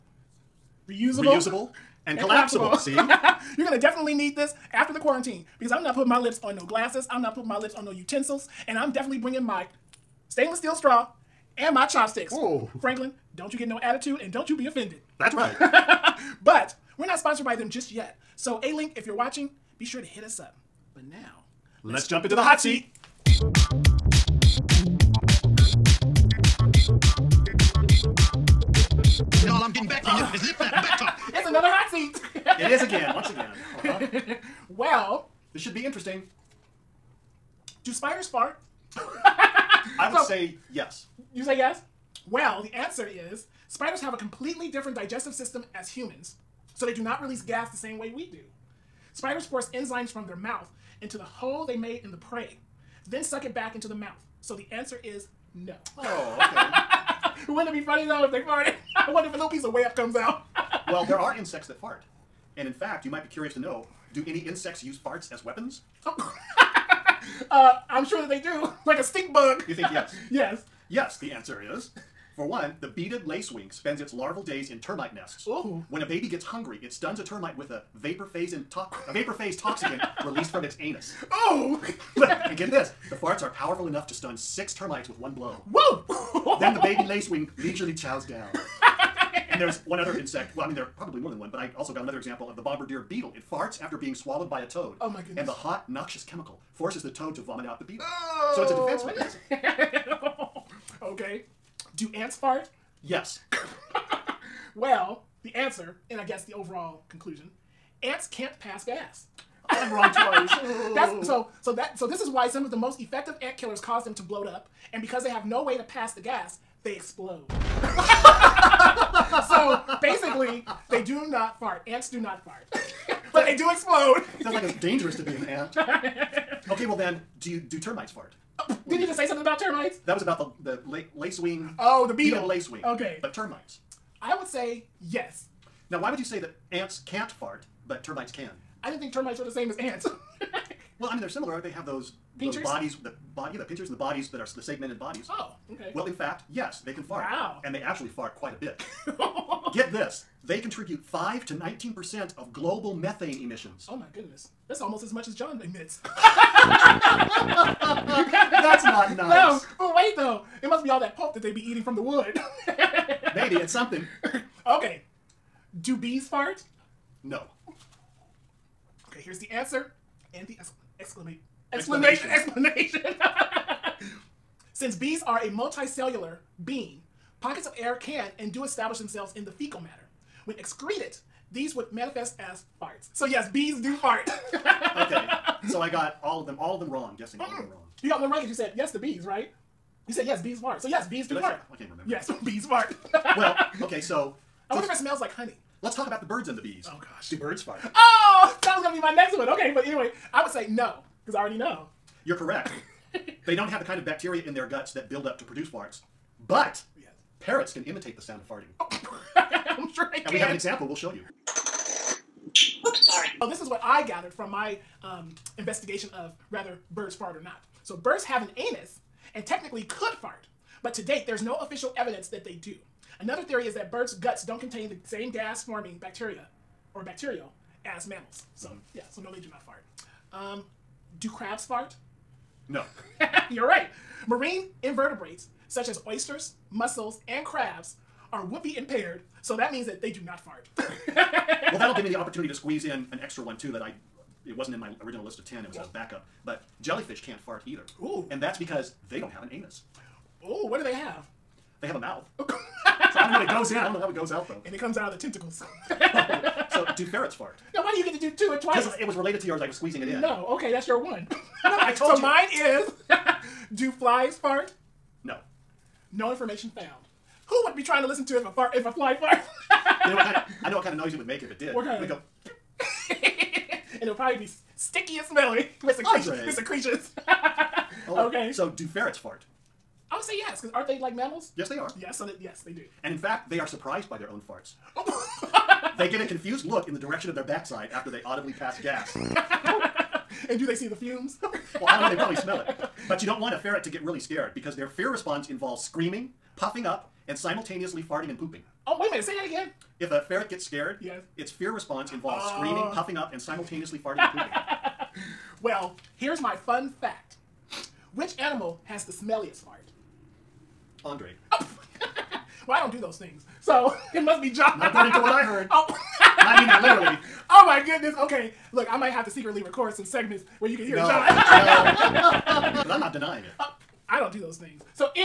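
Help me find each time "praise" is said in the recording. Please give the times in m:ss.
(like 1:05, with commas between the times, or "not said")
not said.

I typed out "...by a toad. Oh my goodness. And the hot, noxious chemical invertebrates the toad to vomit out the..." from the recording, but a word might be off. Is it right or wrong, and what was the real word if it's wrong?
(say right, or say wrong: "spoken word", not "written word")
wrong: "forces", not "invertebrates".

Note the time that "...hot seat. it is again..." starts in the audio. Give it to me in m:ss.
0:31.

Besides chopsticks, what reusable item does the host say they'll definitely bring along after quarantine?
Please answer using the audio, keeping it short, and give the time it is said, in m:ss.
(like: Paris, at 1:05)
stainless steel straw, at 0:10.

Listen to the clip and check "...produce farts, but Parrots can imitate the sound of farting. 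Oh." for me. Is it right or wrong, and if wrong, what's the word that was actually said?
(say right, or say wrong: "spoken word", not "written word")
right.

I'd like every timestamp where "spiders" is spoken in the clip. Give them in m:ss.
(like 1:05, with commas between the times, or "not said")
0:37, 0:43, 0:49.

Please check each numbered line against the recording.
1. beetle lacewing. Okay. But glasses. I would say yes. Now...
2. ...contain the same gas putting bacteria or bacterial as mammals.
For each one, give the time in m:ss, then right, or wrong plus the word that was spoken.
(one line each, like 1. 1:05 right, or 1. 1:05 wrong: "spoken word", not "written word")
1. 2:12 wrong: "termites", not "glasses"
2. 3:44 wrong: "forming", not "putting".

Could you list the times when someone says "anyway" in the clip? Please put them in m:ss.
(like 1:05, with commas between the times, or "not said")
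3:19.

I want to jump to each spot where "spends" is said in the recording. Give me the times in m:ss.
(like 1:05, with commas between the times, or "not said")
1:13.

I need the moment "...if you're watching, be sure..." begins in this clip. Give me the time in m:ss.
0:18.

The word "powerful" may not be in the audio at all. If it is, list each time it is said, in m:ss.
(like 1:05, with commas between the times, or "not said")
1:23.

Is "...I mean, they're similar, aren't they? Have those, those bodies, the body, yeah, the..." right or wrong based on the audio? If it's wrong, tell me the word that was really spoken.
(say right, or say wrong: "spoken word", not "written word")
right.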